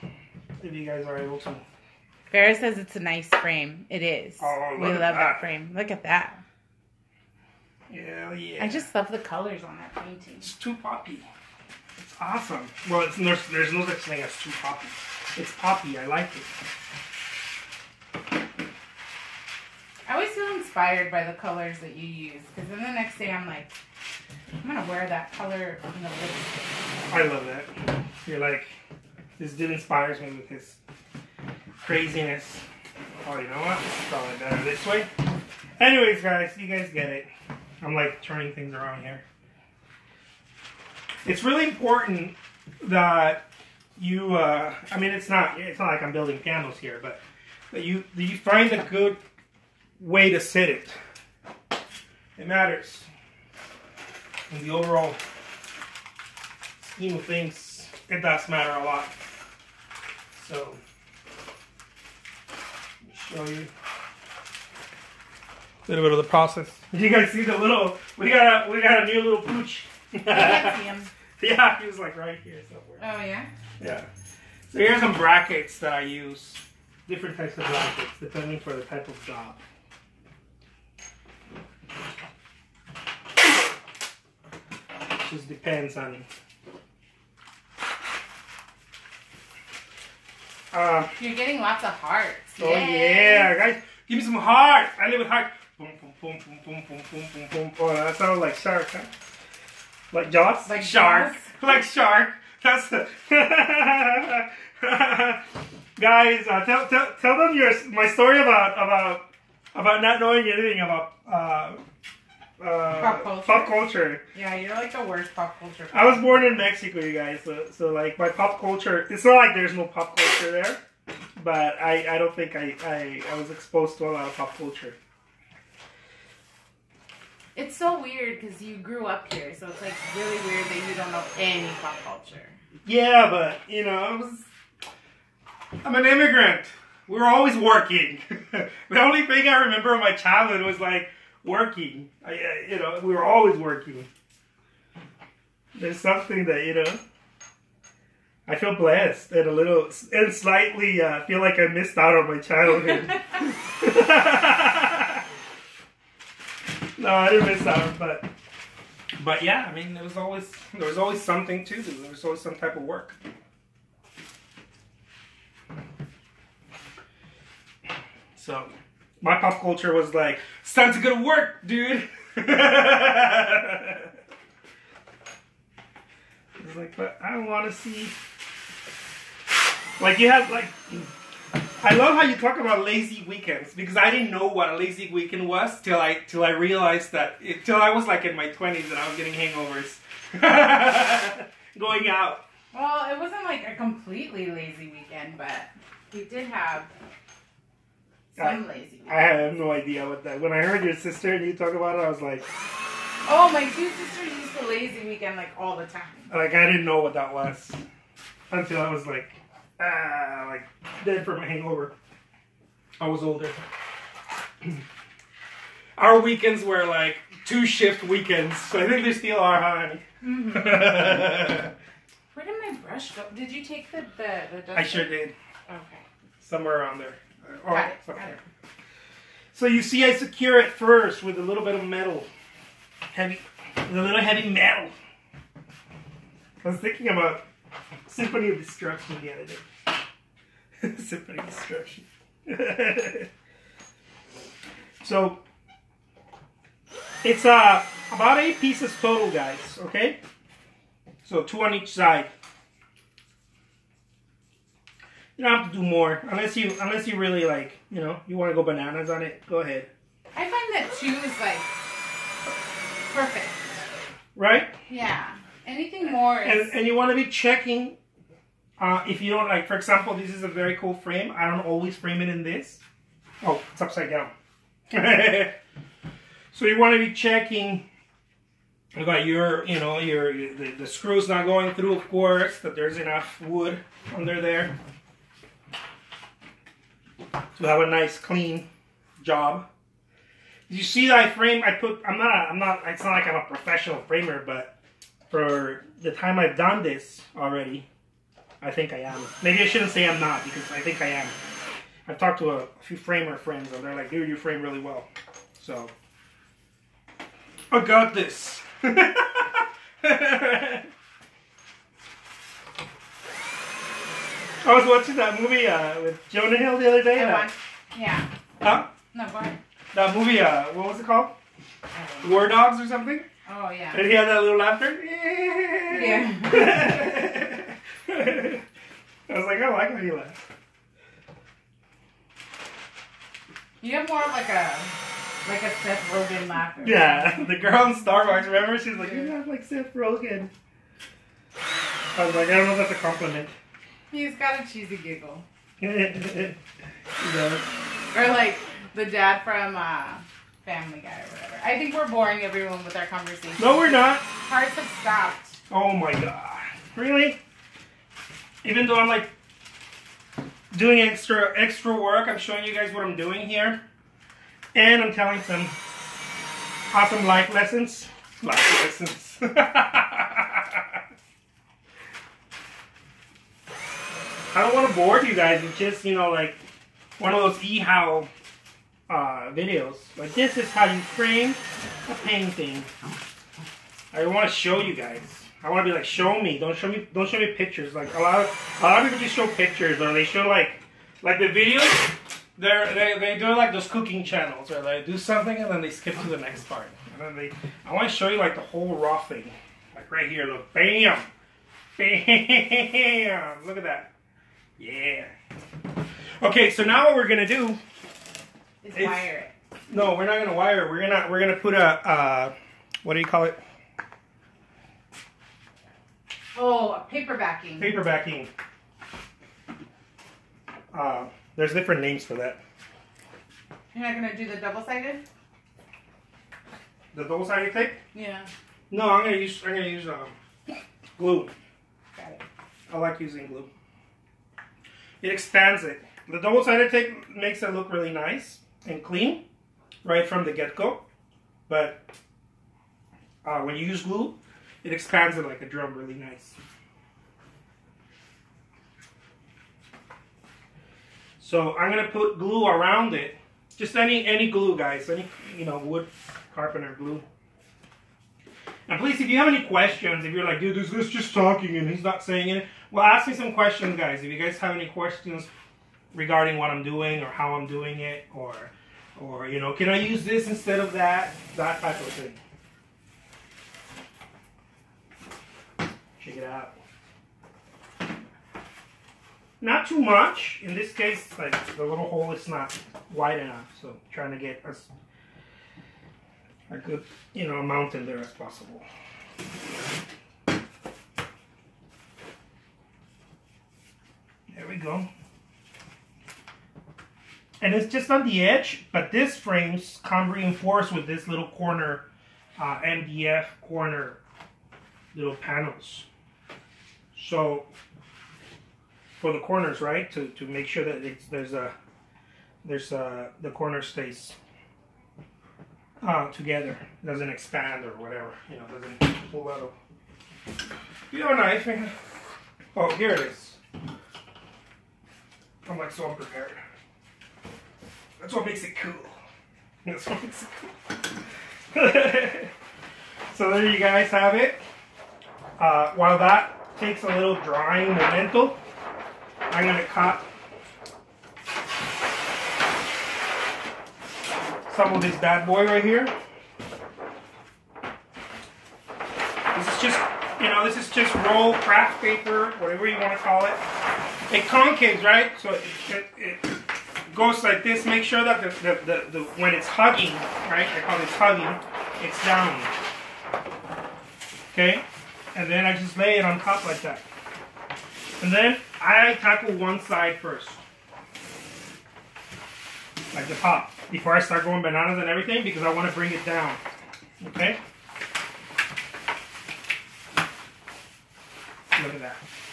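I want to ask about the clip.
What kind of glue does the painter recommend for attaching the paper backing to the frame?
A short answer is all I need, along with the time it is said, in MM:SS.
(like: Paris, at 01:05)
Wood carpenter glue, at 07:35.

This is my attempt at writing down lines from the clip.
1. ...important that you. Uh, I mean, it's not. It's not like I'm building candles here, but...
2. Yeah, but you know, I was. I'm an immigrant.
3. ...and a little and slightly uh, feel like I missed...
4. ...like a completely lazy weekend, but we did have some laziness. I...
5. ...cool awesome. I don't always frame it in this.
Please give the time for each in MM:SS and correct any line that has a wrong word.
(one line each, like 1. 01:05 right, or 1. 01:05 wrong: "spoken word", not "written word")
1. 00:41 right
2. 02:12 right
3. 02:29 right
4. 03:13 right
5. 04:30 wrong: "frame", not "awesome".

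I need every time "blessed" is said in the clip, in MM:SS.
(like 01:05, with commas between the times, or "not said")
02:28.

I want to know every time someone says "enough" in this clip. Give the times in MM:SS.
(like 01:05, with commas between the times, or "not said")
04:42, 08:03.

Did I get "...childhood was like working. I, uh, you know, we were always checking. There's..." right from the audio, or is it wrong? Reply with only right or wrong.
wrong.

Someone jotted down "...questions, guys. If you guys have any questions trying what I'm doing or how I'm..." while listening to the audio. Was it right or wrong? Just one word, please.
wrong.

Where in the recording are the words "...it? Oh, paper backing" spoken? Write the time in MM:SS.
06:53.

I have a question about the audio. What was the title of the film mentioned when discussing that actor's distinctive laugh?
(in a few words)
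War Dogs.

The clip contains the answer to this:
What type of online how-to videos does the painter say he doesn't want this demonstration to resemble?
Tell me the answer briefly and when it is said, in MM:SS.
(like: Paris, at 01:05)
eHow, at 06:17.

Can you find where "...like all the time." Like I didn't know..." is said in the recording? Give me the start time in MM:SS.
03:25.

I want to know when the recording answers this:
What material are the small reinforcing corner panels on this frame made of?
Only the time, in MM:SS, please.
08:22.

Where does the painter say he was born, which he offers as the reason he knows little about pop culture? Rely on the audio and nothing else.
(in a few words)
Mexico.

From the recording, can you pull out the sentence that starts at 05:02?
I've talked to a few framer friends, and they're like, dude, you frame really well.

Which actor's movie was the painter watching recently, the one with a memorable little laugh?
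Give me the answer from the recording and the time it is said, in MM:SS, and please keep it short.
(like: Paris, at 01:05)
Jonah Hill, at 05:16.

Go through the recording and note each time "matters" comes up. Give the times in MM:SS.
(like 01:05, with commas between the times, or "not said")
00:52, 00:58.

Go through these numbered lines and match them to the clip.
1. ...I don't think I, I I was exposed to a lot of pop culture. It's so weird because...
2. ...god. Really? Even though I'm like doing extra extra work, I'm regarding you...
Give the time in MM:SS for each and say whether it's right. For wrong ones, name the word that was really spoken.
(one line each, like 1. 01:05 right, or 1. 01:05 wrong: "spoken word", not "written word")
1. 02:02 right
2. 05:56 wrong: "showing", not "regarding".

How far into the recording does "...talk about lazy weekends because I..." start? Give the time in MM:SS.
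03:02.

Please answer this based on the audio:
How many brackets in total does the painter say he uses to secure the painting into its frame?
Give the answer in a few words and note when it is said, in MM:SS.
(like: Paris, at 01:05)
8, at 04:08.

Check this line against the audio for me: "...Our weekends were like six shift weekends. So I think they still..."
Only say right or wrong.
wrong.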